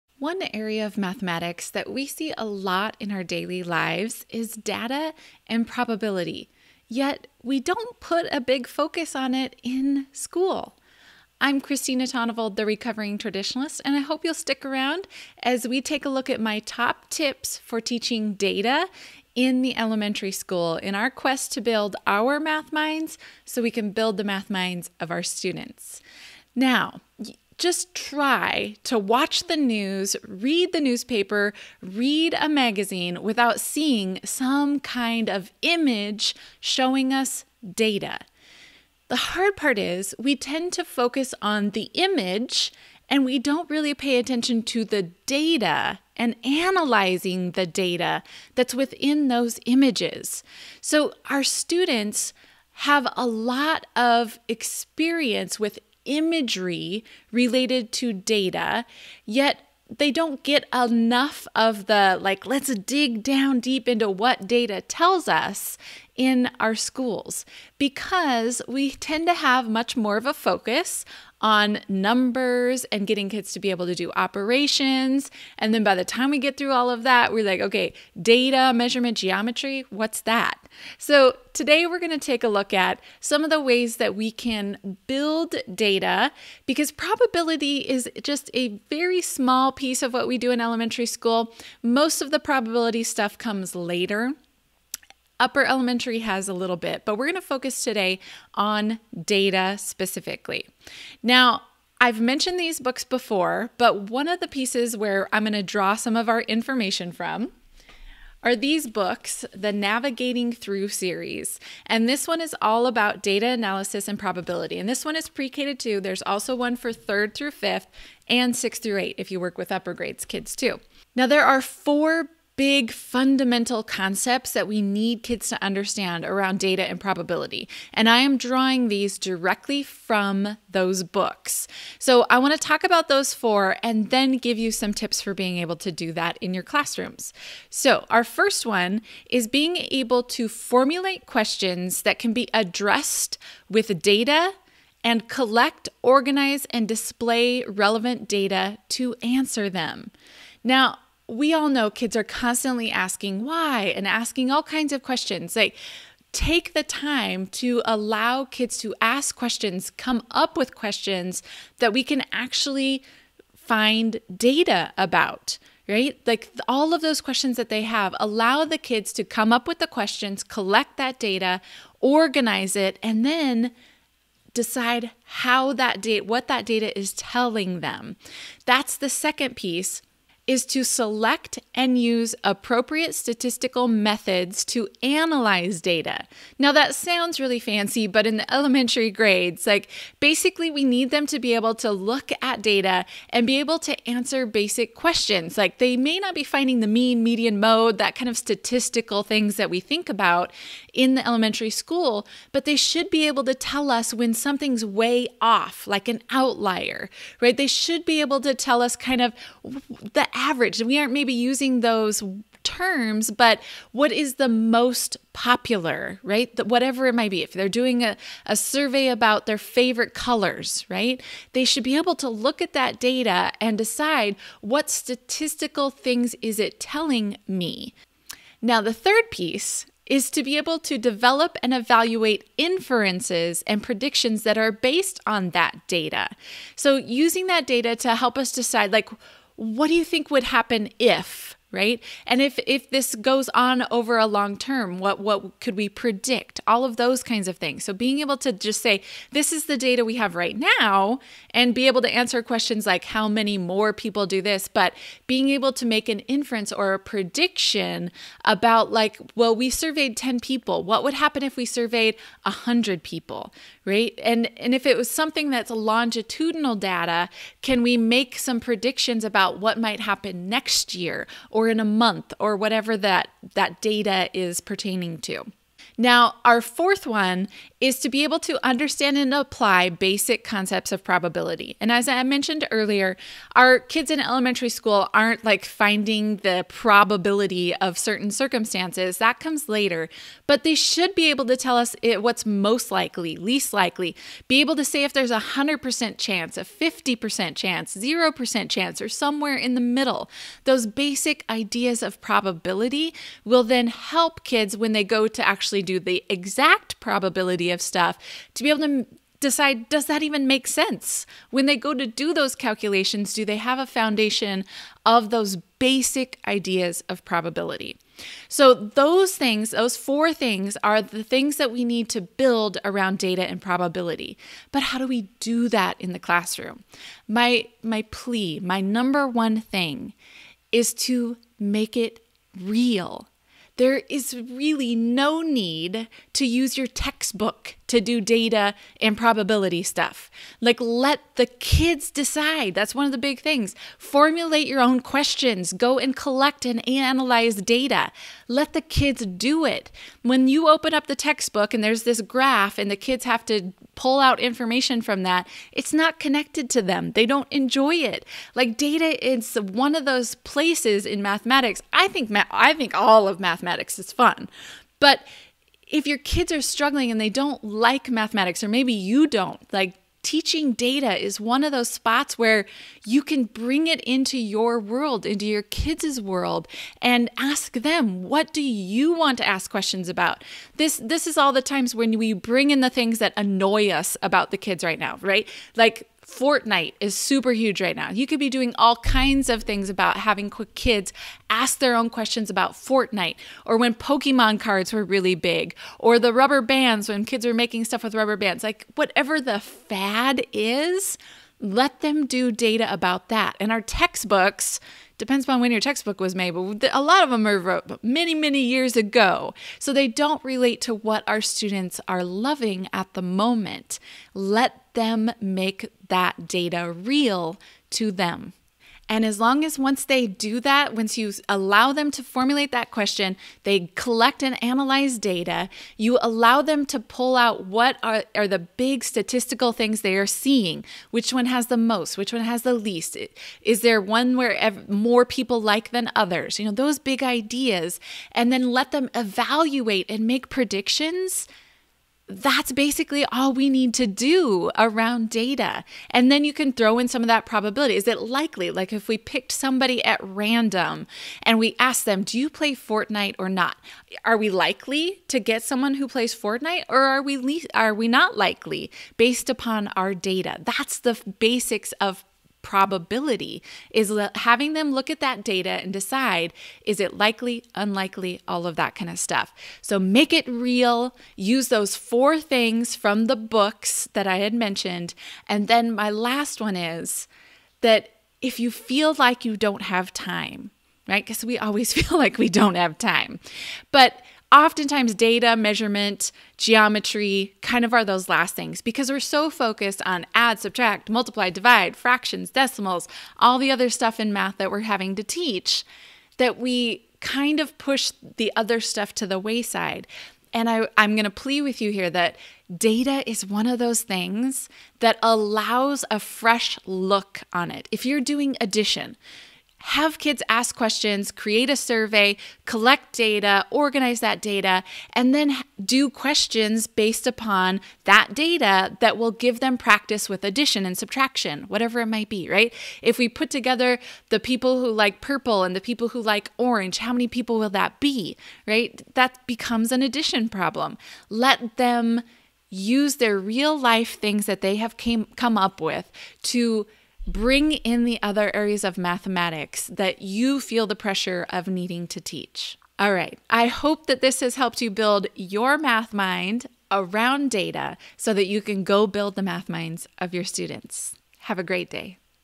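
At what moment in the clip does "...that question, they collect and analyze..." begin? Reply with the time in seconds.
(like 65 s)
422 s.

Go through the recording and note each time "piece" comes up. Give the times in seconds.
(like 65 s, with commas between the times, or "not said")
89 s, 104 s, 179 s, 229 s.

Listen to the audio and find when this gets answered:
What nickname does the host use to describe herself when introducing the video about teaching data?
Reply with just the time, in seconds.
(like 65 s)
12 s.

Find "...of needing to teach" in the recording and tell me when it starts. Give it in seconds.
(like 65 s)
541 s.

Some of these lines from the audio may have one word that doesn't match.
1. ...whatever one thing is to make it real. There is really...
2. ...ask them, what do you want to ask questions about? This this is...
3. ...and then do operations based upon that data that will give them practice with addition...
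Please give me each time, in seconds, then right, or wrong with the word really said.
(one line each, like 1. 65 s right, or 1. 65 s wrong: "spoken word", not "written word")
1. 328 s wrong: "number", not "whatever"
2. 377 s right
3. 515 s wrong: "questions", not "operations".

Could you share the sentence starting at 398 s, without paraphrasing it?
Like, whatever the fad is, let them do data about that.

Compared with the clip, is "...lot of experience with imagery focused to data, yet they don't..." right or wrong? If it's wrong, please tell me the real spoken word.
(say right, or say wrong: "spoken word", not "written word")
wrong: "related", not "focused".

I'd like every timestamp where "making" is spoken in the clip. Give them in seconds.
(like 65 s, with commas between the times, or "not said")
397 s.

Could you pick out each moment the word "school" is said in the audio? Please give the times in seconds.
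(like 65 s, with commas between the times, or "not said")
10 s, 20 s, 66 s, 91 s, 201 s, 284 s.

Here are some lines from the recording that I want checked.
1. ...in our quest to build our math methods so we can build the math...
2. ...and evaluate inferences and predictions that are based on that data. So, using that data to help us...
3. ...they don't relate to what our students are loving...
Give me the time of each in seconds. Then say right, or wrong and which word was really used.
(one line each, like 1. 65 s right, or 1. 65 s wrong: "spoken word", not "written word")
1. 20 s wrong: "minds", not "methods"
2. 231 s right
3. 409 s right.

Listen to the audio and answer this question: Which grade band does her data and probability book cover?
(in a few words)
pre K to 2.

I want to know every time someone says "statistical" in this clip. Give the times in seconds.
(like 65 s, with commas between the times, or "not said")
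183 s, 198 s, 224 s, 429 s.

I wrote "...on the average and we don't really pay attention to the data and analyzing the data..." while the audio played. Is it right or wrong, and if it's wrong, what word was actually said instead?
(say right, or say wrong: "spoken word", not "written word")
wrong: "image", not "average".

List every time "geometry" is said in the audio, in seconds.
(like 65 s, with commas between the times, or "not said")
79 s, 486 s.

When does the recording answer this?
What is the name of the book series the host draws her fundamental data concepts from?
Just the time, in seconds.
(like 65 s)
109 s.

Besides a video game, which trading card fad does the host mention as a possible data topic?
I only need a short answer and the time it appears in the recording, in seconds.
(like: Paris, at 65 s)
Pokemon cards, at 393 s.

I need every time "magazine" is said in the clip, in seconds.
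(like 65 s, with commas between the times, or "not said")
32 s.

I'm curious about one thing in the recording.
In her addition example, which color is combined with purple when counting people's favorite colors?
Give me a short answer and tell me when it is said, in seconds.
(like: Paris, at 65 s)
orange, at 526 s.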